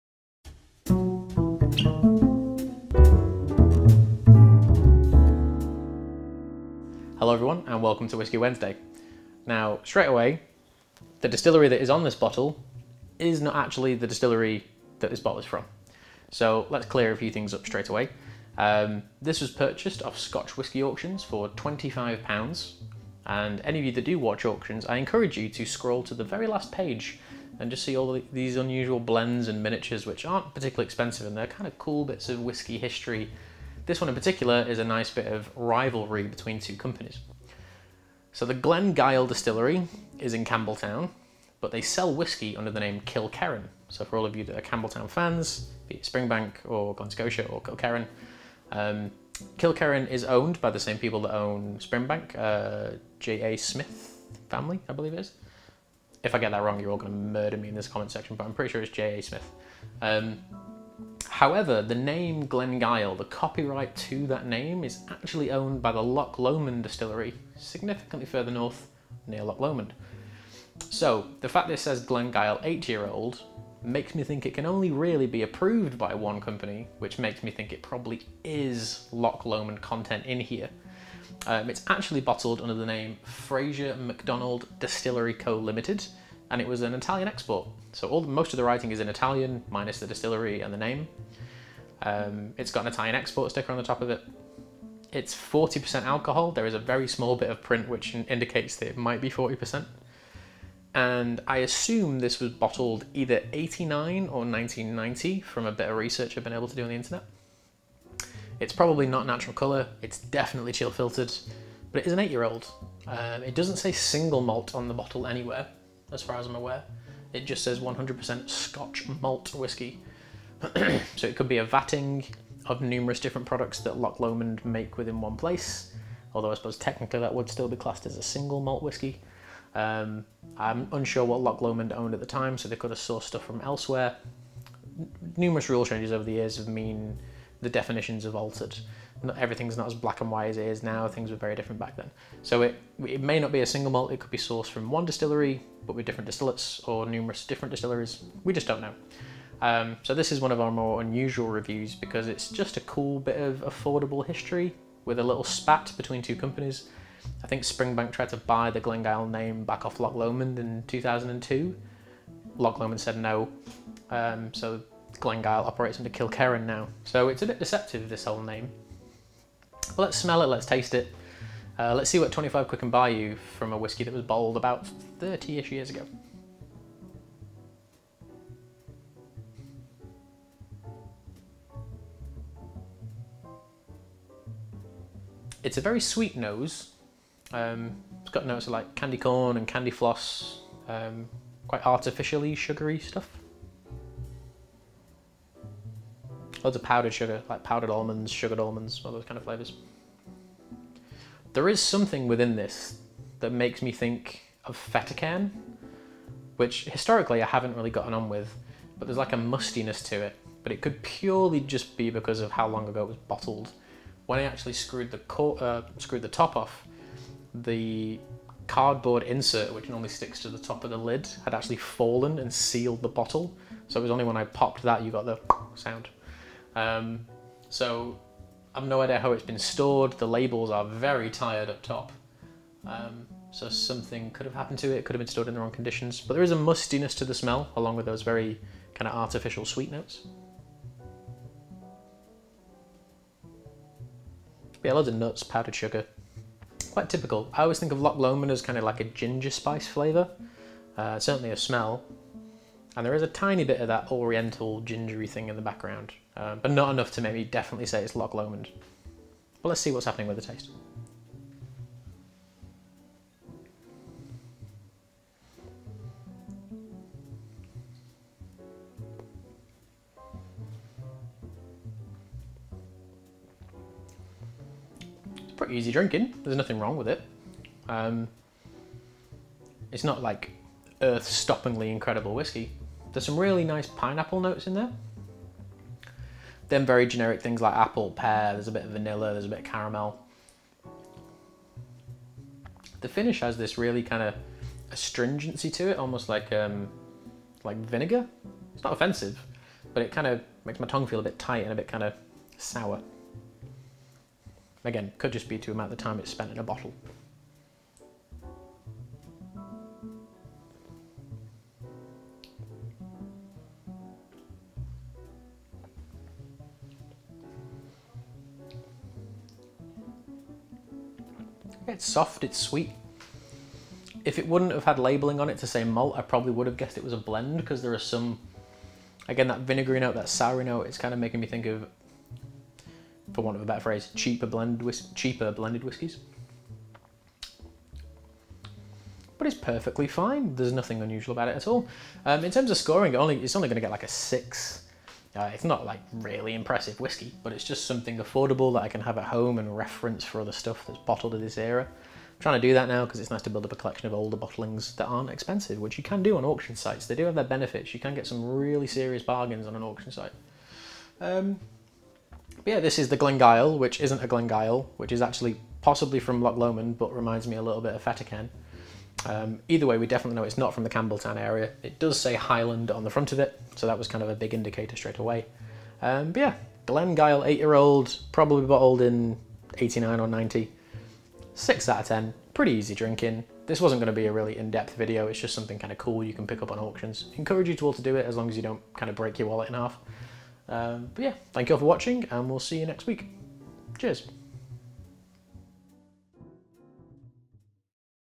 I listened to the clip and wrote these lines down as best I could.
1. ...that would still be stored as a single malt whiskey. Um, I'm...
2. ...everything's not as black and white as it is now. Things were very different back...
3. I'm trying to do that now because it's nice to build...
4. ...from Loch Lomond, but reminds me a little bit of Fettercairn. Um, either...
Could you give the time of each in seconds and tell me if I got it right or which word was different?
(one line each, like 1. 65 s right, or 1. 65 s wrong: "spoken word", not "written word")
1. 127 s wrong: "classed", not "stored"
2. 139 s right
3. 351 s right
4. 366 s right.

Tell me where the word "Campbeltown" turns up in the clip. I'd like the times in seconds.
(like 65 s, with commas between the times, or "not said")
40 s, 44 s, 370 s.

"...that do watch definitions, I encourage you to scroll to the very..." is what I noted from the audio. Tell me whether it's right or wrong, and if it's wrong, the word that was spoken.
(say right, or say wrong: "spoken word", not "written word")
wrong: "auctions", not "definitions".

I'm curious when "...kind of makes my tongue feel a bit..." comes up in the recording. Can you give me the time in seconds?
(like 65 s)
300 s.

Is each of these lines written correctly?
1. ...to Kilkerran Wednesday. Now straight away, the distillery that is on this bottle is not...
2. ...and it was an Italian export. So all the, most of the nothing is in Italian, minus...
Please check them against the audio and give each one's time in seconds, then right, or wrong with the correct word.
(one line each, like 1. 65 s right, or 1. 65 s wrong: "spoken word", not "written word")
1. 8 s wrong: "Whisky", not "Kilkerran"
2. 86 s wrong: "writing", not "nothing".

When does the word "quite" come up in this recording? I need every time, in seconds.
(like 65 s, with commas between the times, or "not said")
191 s, 246 s.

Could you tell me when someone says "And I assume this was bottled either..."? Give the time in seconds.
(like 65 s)
100 s.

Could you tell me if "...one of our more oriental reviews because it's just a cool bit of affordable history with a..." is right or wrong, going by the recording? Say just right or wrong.
wrong.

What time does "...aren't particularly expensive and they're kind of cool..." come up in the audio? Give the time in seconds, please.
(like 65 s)
30 s.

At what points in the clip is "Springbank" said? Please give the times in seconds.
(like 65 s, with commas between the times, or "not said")
46 s, 51 s, 157 s.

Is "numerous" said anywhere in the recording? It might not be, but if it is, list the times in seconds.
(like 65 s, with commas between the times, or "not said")
122 s, 135 s, 147 s.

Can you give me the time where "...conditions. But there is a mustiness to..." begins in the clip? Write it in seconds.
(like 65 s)
235 s.